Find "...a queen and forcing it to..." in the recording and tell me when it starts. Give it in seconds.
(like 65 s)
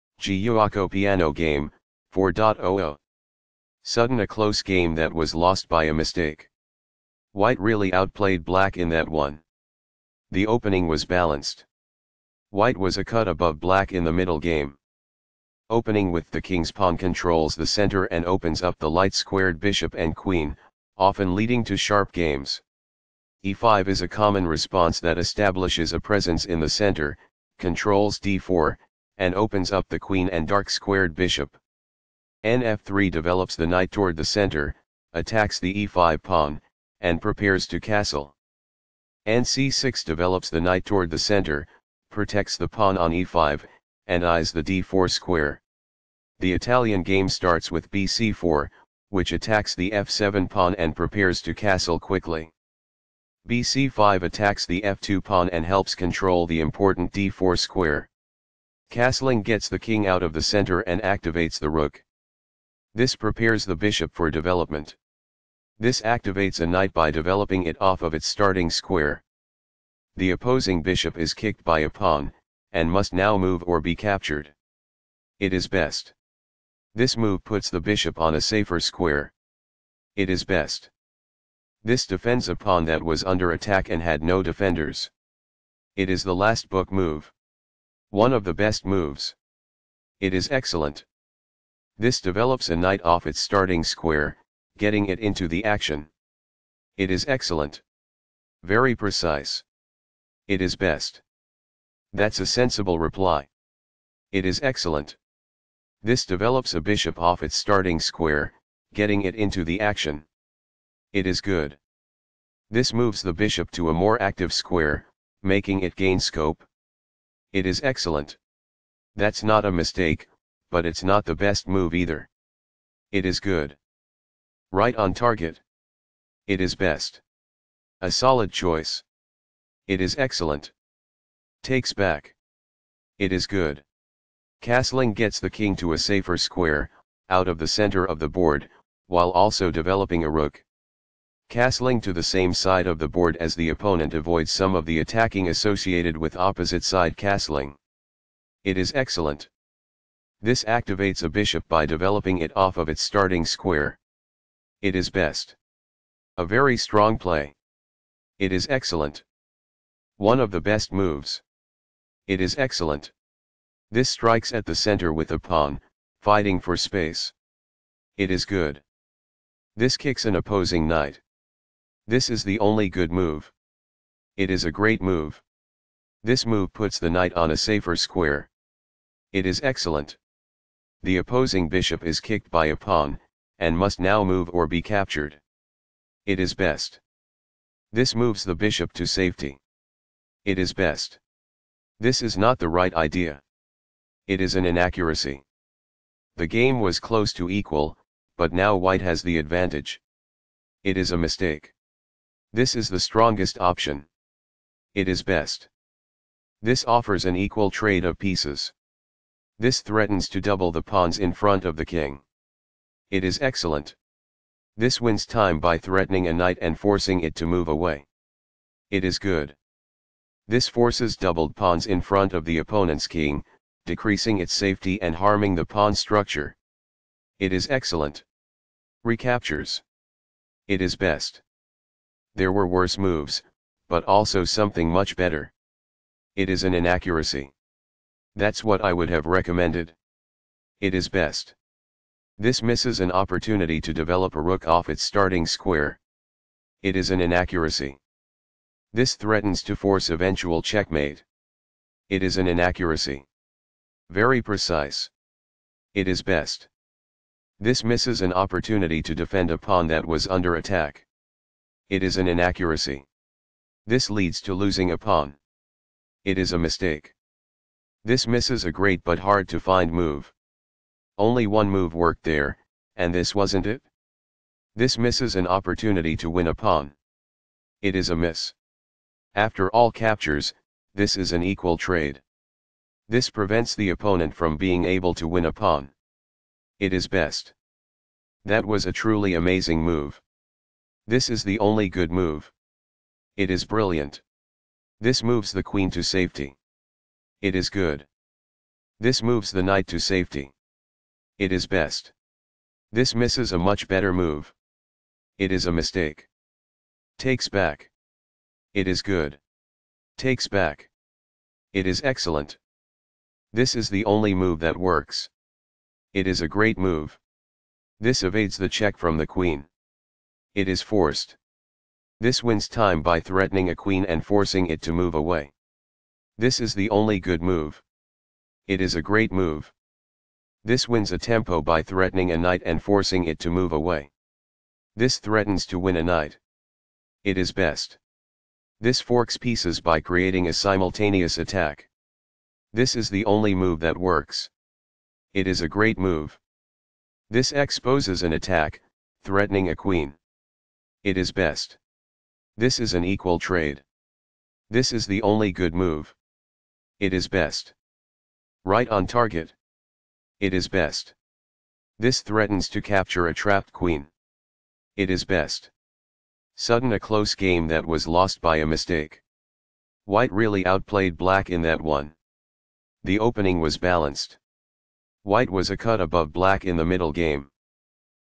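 323 s.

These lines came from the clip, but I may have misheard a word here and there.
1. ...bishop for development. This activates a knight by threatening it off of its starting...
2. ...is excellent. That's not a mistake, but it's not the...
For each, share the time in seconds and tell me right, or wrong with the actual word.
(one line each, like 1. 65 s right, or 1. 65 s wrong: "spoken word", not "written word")
1. 63 s wrong: "developing", not "threatening"
2. 117 s right.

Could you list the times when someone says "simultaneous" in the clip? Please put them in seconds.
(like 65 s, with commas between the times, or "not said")
340 s.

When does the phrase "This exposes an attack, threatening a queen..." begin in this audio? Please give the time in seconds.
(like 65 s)
347 s.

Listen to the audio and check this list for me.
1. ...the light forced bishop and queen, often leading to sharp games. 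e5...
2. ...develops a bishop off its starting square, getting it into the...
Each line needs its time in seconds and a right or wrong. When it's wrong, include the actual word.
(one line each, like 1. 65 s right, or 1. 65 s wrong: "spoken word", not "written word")
1. 18 s wrong: "squared", not "forced"
2. 106 s right.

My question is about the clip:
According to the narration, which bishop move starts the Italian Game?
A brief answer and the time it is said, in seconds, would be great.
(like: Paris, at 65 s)
Bc4, at 47 s.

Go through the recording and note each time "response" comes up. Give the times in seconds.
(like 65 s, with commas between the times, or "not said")
24 s.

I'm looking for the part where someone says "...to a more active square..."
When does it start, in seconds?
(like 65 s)
113 s.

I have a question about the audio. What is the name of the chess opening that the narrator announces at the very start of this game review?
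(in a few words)
Giuoco Piano Game.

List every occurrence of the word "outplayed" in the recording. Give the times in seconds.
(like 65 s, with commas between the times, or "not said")
7 s, 370 s.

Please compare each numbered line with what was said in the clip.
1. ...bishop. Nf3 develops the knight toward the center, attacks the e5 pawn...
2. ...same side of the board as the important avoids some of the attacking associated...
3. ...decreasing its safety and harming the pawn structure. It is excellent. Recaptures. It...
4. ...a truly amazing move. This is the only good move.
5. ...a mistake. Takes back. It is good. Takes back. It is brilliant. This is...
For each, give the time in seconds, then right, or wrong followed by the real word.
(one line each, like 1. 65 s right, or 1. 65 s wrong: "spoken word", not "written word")
1. 31 s right
2. 142 s wrong: "opponent", not "important"
3. 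223 s right
4. 288 s right
5. 305 s wrong: "excellent", not "brilliant".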